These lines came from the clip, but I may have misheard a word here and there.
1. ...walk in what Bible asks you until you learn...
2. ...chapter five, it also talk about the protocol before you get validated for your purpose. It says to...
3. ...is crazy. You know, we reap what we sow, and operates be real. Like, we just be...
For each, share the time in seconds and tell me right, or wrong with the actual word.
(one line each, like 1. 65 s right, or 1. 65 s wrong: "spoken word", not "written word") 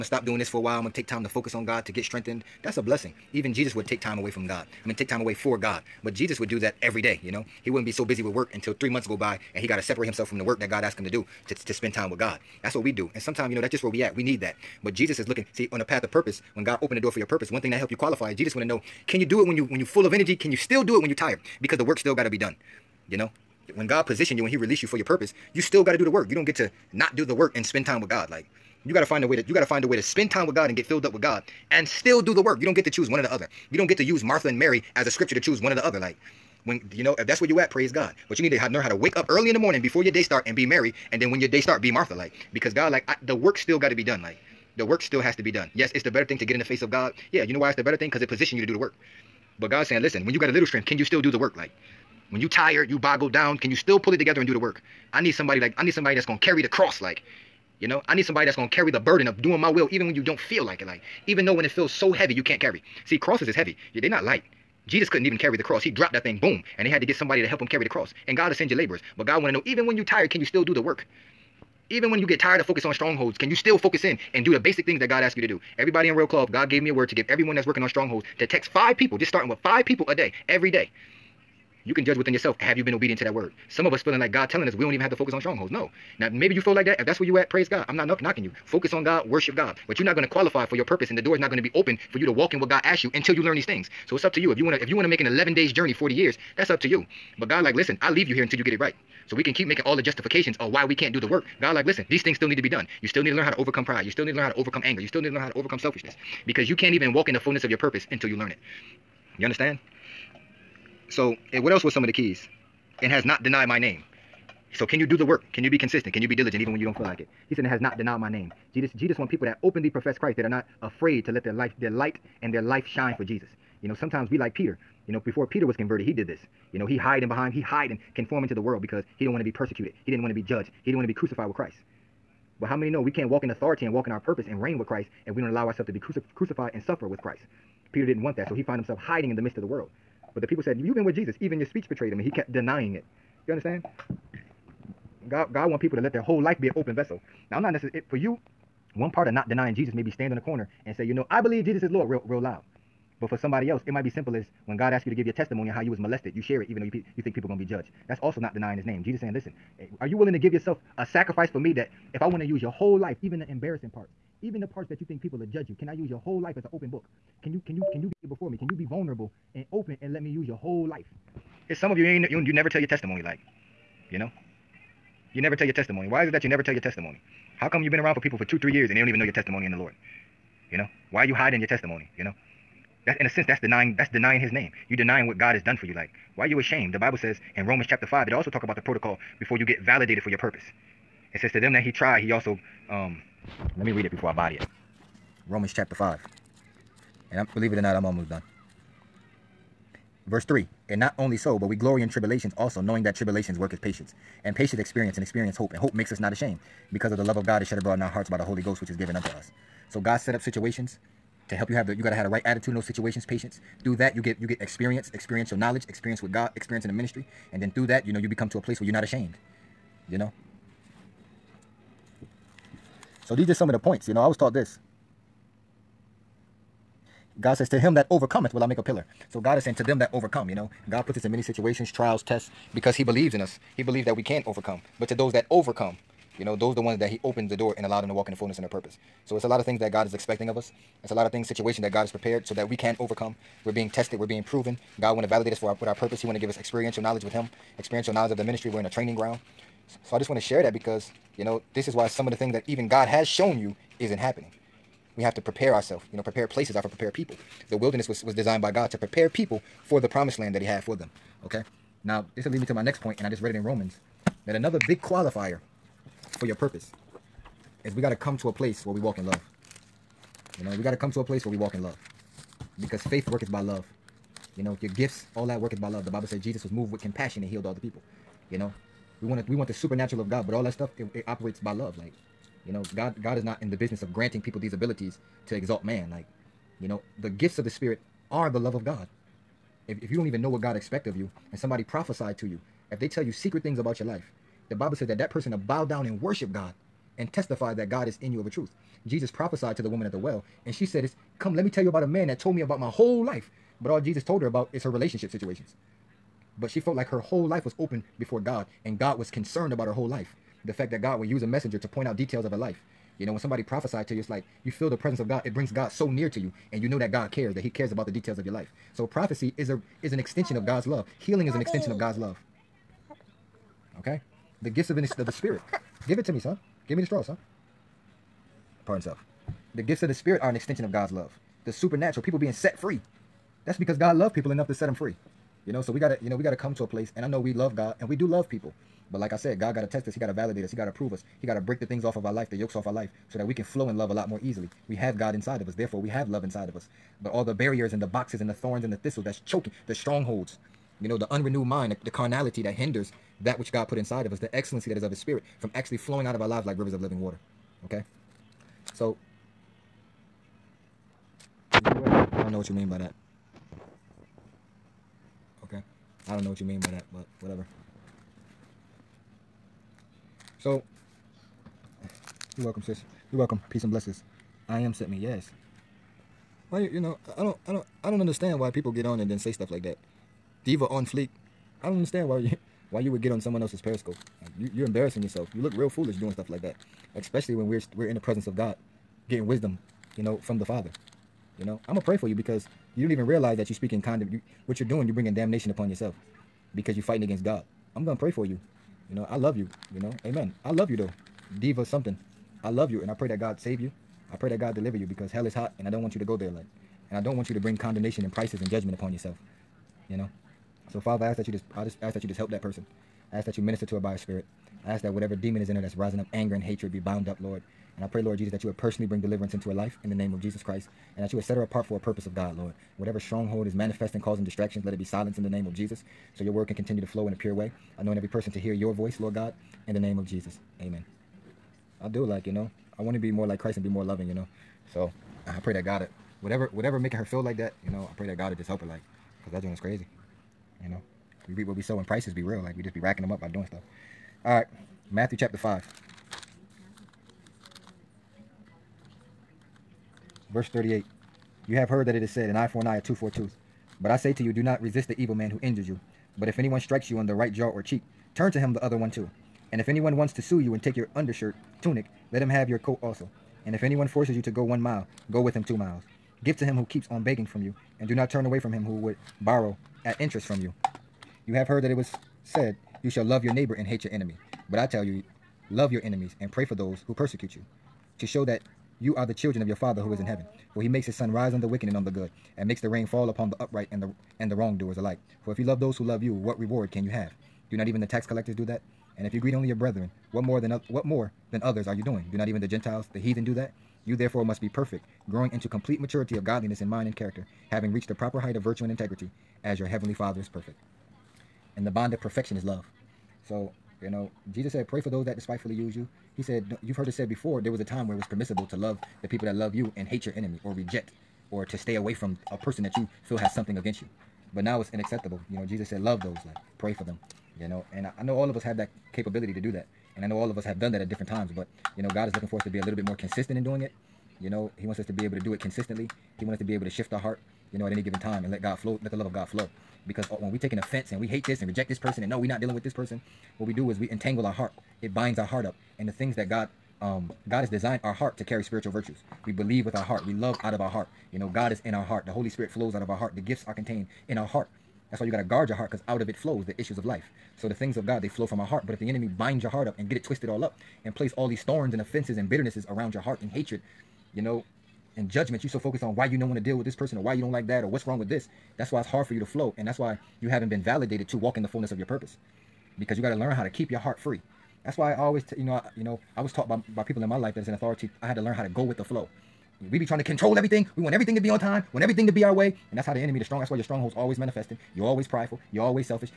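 1. 92 s wrong: "God", not "Bible"
2. 187 s right
3. 439 s wrong: "prices", not "operates".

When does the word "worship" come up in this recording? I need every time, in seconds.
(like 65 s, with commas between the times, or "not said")
89 s, 296 s.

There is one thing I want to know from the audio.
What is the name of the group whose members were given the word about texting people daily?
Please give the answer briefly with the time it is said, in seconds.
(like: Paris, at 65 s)
Royal Cloth, at 76 s.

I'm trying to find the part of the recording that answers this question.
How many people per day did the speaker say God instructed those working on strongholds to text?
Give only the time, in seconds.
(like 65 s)
79 s.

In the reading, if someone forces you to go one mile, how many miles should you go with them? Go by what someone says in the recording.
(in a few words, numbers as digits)
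2.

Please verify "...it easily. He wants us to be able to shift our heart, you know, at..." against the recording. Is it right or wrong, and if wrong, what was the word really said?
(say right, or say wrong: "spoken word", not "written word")
wrong: "consistently", not "easily".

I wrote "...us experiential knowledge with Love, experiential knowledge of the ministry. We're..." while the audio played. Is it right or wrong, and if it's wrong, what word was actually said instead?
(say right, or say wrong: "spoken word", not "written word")
wrong: "Him", not "Love".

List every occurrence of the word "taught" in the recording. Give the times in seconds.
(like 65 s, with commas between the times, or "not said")
224 s, 566 s.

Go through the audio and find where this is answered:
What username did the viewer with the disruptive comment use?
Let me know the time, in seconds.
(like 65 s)
380 s.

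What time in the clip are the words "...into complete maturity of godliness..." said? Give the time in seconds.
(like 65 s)
495 s.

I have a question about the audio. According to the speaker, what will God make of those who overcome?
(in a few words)
a pillar.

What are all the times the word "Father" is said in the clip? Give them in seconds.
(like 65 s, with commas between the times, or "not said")
390 s, 411 s, 479 s, 500 s.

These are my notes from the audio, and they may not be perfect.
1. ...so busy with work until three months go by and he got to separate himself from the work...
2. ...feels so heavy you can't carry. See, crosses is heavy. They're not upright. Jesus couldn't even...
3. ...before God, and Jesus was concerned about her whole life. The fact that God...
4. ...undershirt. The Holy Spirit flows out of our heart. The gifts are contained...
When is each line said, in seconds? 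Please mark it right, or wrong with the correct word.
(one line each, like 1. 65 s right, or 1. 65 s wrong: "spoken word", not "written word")
1. 7 s right
2. 61 s wrong: "light", not "upright"
3. 308 s wrong: "God", not "Jesus"
4. 542 s wrong: "heart", not "undershirt".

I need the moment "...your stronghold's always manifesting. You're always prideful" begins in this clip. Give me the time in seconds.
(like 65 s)
573 s.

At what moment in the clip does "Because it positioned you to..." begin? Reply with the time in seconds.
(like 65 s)
48 s.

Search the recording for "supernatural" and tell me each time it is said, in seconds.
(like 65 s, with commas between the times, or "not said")
279 s, 331 s.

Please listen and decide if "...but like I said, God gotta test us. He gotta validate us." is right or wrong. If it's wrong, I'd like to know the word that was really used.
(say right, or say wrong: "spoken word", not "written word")
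right.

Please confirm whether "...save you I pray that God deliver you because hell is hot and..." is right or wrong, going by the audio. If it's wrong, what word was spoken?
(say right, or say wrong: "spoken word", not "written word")
right.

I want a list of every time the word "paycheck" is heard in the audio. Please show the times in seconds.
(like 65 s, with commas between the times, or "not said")
not said.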